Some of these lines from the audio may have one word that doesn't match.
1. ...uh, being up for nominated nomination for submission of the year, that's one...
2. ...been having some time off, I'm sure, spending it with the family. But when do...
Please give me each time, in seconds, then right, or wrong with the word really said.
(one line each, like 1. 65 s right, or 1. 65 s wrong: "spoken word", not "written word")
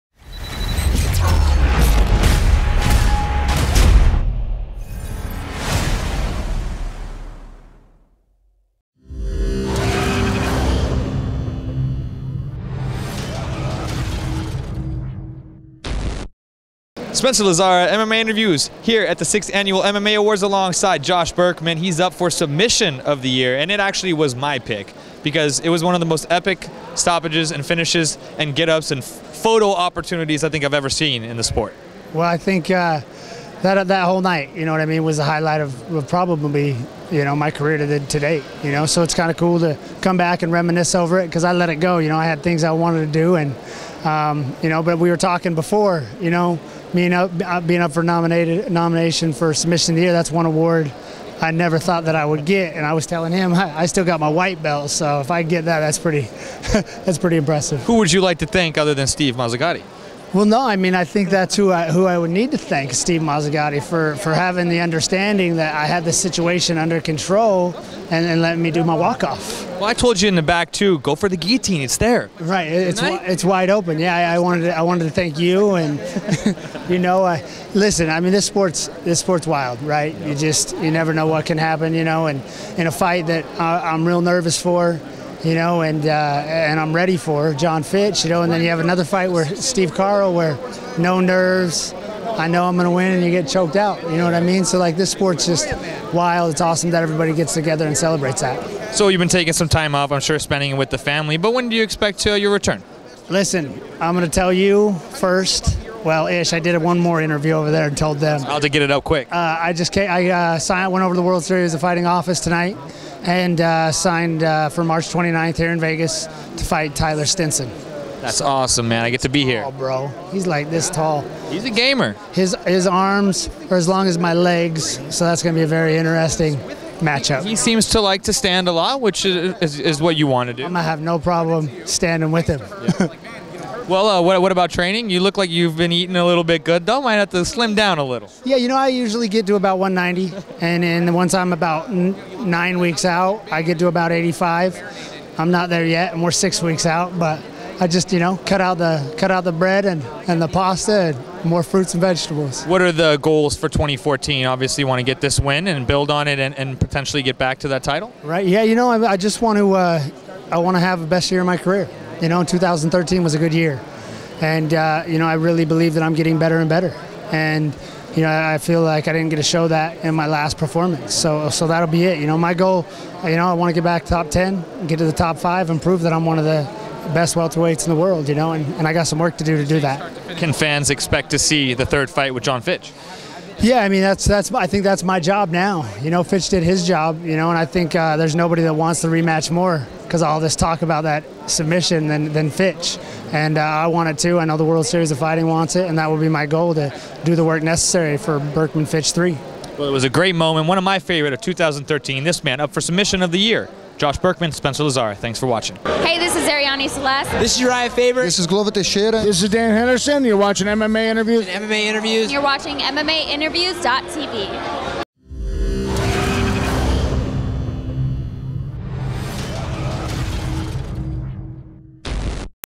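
1. 47 s right
2. 99 s wrong: "taking", not "having".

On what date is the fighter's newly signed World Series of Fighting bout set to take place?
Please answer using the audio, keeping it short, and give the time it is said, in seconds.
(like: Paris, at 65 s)
March 29th, at 114 s.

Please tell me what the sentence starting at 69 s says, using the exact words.
Well, I told you in the back, too, go for the guillotine.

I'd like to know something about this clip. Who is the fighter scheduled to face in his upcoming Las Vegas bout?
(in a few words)
Tyler Stinson.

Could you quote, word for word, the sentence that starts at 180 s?
Can fans expect to see the third fight with Jon Fitch?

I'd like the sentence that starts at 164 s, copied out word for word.
And, uh, you know, I really believe that I'm getting better and better.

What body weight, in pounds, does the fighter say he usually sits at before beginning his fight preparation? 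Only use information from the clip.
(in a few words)
190.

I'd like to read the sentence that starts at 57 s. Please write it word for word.
Who would you like to thank other than Steve Mazzagatti?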